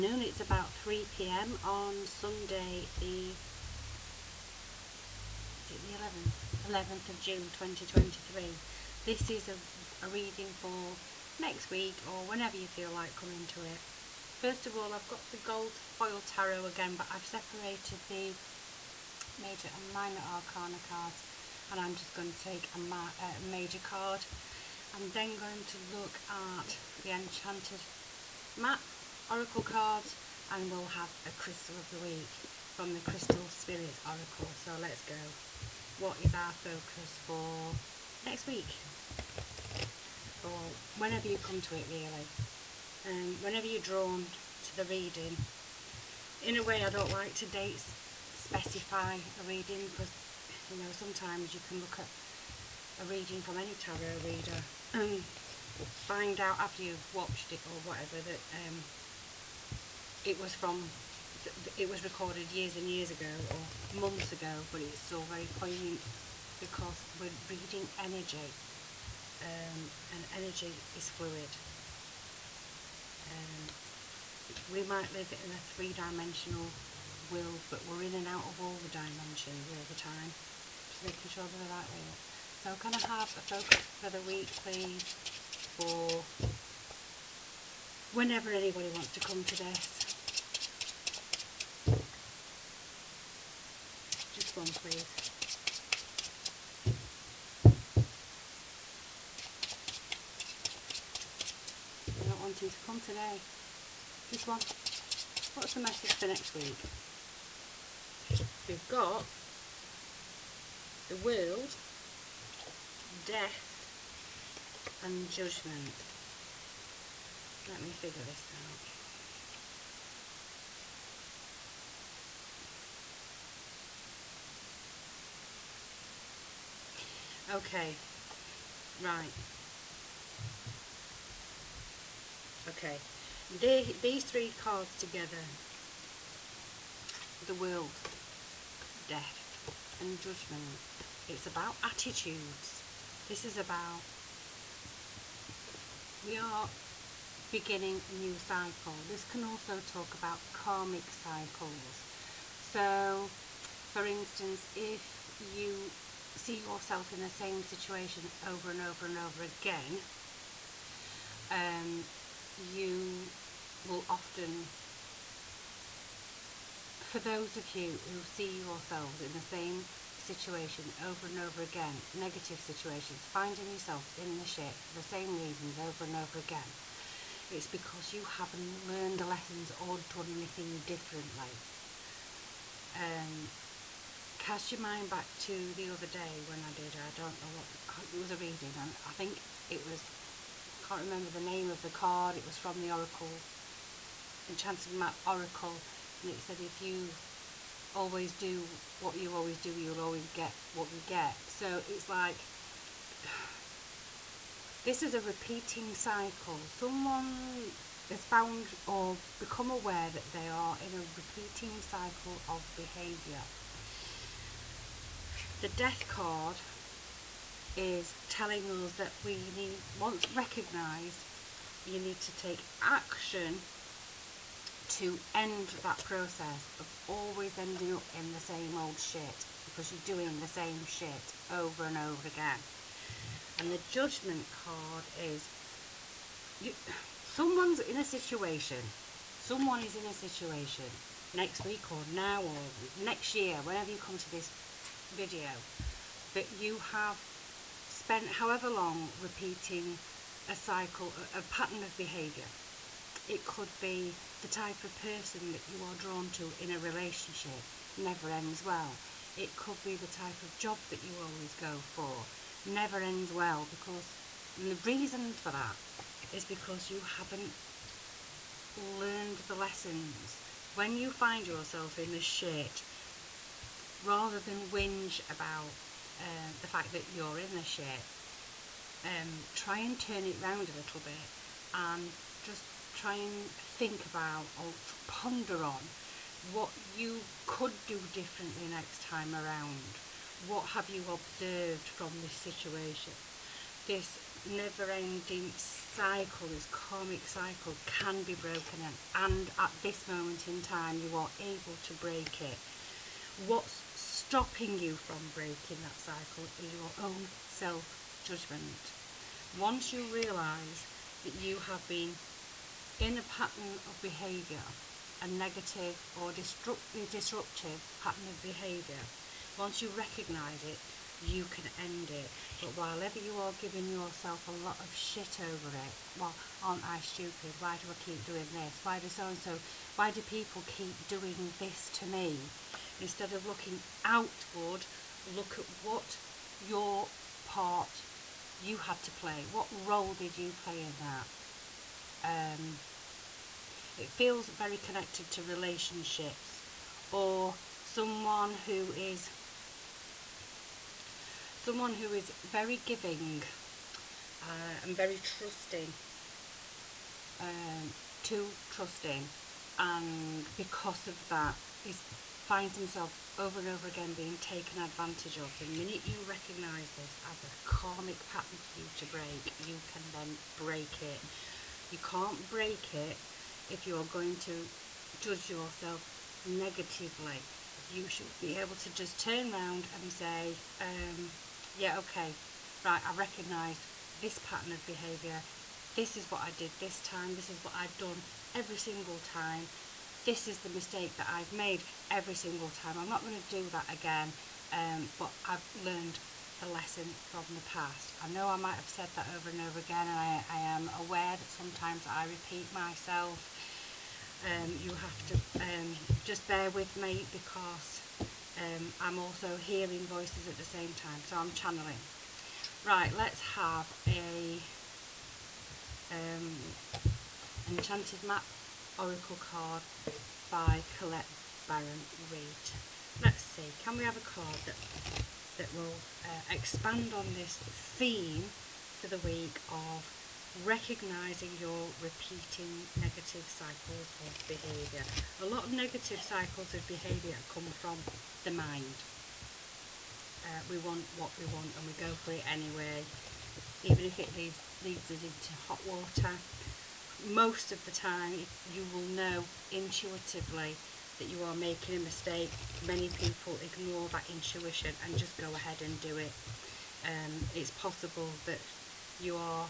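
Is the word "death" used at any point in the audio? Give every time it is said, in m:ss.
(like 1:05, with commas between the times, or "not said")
1:53, 2:19, 3:35.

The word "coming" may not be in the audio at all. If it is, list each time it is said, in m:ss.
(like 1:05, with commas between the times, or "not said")
0:13.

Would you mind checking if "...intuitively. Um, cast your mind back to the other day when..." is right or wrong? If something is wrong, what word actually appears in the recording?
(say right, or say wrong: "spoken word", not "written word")
wrong: "differently", not "intuitively".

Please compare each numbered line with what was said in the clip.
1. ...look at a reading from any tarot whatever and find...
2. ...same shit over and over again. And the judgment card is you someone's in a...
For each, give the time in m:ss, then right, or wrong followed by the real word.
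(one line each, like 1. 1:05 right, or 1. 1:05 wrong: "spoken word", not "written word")
1. 0:51 wrong: "reader", not "whatever"
2. 3:50 right.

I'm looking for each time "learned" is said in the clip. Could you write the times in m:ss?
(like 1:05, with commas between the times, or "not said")
2:58, 4:28, 6:35.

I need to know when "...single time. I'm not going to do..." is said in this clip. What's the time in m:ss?
6:32.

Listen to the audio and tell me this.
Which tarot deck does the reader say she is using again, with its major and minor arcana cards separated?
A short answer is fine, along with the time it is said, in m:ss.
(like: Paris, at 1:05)
gold foil tarot, at 0:15.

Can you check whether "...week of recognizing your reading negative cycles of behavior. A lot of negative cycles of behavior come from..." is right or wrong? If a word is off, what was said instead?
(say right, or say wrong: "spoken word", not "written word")
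wrong: "repeating", not "reading".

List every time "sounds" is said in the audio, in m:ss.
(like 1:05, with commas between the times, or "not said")
not said.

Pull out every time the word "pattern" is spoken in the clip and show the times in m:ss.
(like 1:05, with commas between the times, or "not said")
4:11, 5:13, 5:17, 6:08, 6:24.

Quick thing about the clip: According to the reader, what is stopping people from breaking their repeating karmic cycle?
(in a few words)
self-judgment.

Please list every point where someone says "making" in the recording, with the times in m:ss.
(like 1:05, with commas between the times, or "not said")
1:21, 7:31.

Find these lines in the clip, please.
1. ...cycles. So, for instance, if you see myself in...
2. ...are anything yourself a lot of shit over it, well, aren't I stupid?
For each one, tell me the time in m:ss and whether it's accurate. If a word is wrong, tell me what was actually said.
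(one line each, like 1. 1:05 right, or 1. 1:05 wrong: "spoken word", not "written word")
1. 2:31 wrong: "yourself", not "myself"
2. 5:23 wrong: "giving", not "anything".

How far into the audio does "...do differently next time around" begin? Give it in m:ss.
4:47.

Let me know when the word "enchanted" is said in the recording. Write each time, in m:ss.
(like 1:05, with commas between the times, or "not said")
0:27, 3:14, 6:57.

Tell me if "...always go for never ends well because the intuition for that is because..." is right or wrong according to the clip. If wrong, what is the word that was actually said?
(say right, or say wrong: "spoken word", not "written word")
wrong: "reason", not "intuition".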